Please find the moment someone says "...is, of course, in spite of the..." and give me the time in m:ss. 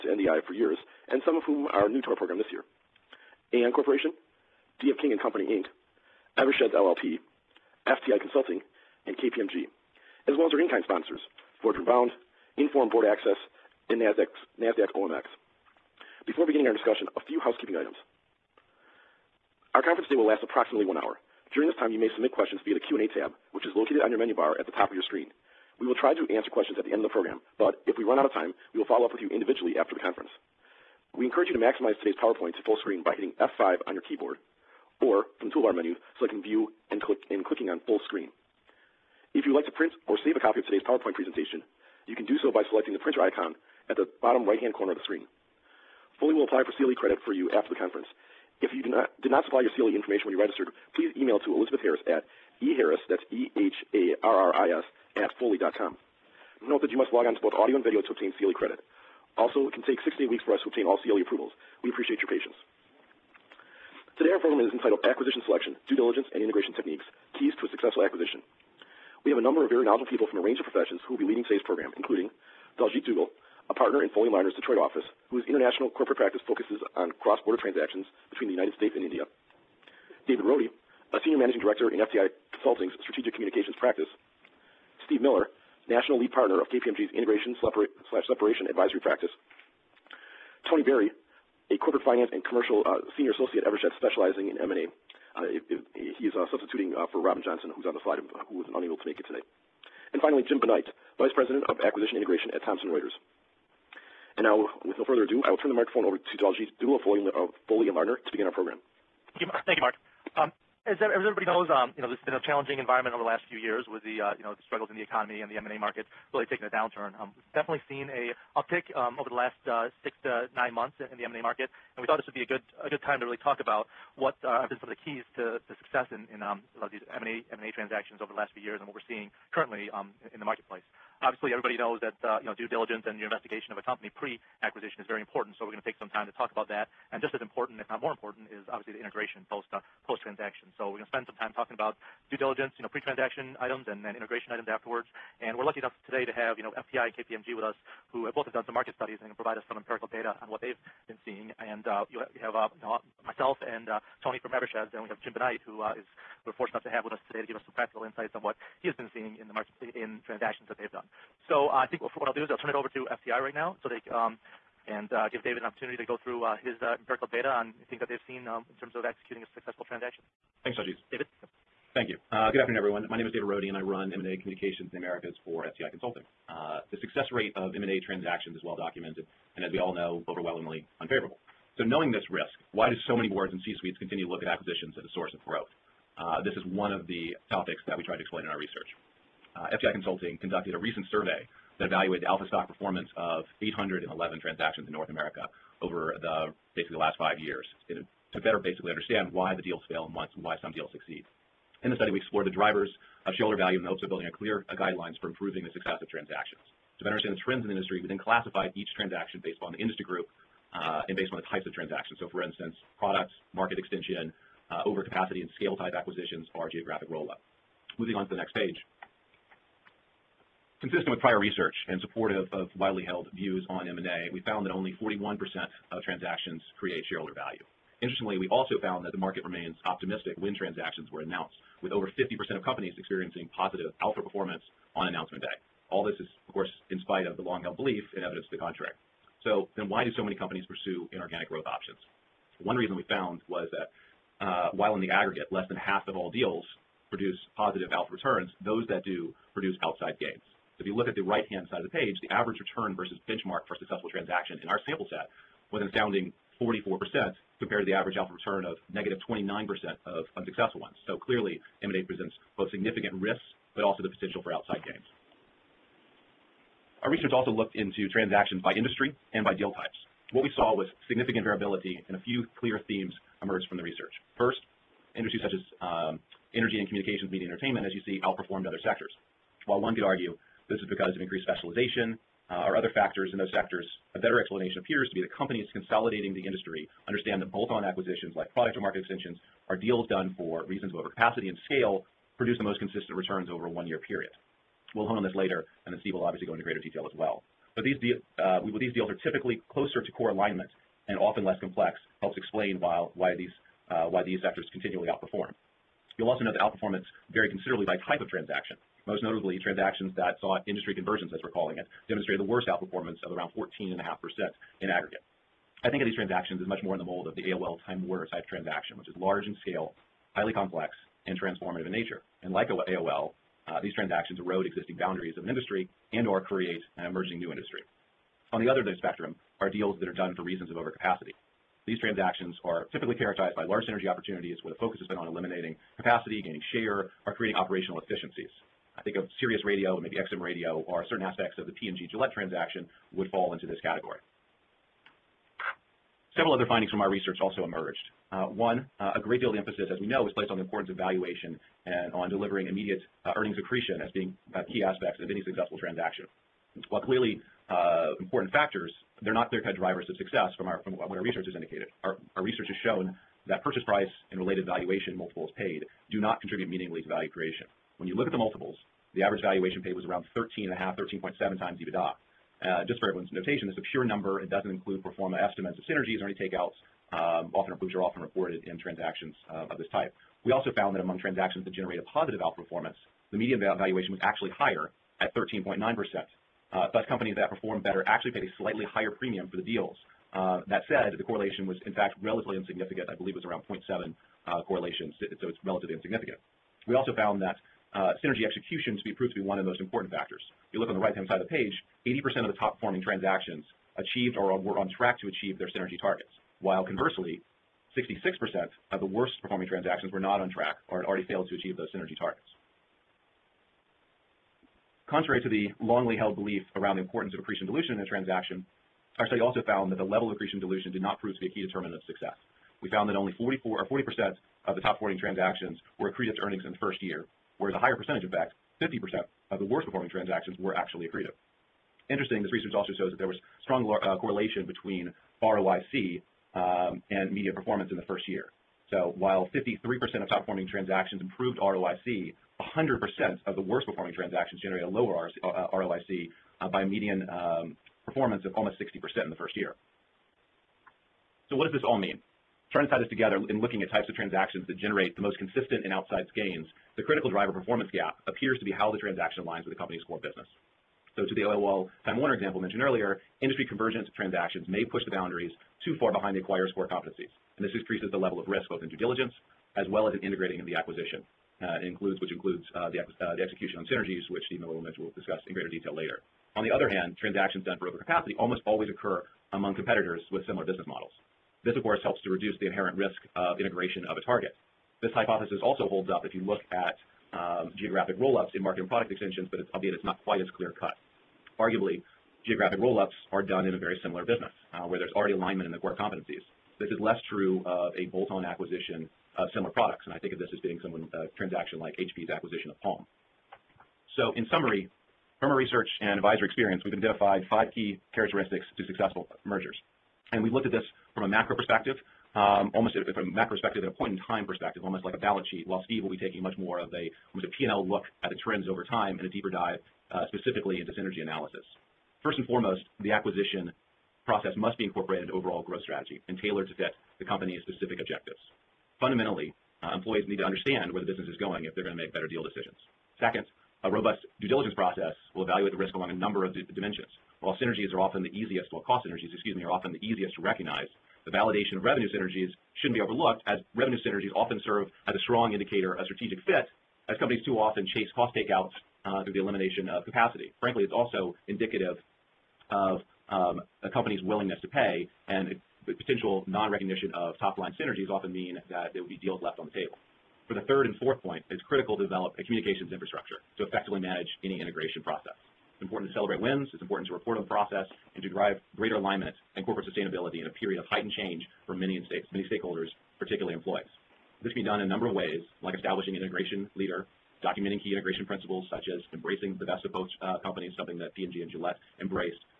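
3:56.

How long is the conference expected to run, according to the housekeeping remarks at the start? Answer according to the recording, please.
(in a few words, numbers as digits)
approximately one hour.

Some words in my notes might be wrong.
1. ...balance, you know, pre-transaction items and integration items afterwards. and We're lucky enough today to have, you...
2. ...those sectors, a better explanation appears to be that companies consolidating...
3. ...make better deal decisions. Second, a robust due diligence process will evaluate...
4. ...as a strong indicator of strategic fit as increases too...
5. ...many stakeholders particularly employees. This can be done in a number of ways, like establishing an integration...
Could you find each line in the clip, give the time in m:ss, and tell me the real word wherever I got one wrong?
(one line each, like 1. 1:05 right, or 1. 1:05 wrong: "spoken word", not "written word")
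1. 2:22 wrong: "diligence", not "balance"
2. 4:43 right
3. 8:51 right
4. 9:05 wrong: "companies", not "increases"
5. 9:32 right.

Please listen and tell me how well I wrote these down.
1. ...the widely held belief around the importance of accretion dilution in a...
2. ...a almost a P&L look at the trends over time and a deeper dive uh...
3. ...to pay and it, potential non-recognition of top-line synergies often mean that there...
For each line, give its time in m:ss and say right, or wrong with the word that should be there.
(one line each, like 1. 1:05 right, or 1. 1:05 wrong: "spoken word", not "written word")
1. 6:55 wrong: "longly", not "widely"
2. 8:36 right
3. 9:14 right.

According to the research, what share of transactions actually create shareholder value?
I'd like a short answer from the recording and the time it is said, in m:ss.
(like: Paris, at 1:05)
41%, at 3:45.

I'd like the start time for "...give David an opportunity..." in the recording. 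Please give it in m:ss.
2:45.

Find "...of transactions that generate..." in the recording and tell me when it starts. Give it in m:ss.
7:34.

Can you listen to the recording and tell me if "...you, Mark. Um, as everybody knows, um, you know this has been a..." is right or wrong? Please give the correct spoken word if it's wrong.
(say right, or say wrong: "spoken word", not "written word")
right.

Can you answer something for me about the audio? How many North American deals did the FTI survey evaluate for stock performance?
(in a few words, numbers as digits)
811.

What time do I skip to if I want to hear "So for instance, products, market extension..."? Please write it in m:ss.
3:32.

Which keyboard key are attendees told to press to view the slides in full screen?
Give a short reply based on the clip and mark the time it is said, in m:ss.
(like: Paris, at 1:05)
F5, at 0:33.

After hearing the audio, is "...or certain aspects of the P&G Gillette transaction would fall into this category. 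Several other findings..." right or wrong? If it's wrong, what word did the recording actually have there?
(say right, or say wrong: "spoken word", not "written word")
right.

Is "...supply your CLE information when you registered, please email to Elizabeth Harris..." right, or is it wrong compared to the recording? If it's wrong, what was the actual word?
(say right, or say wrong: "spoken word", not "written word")
right.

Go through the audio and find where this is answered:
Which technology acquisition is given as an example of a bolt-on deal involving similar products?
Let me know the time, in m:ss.
8:21.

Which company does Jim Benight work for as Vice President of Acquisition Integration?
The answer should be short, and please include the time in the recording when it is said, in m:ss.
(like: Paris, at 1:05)
Thomson Reuters, at 1:42.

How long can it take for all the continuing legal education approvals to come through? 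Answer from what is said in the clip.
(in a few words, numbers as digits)
six to eight weeks.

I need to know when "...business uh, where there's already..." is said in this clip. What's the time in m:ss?
8:14.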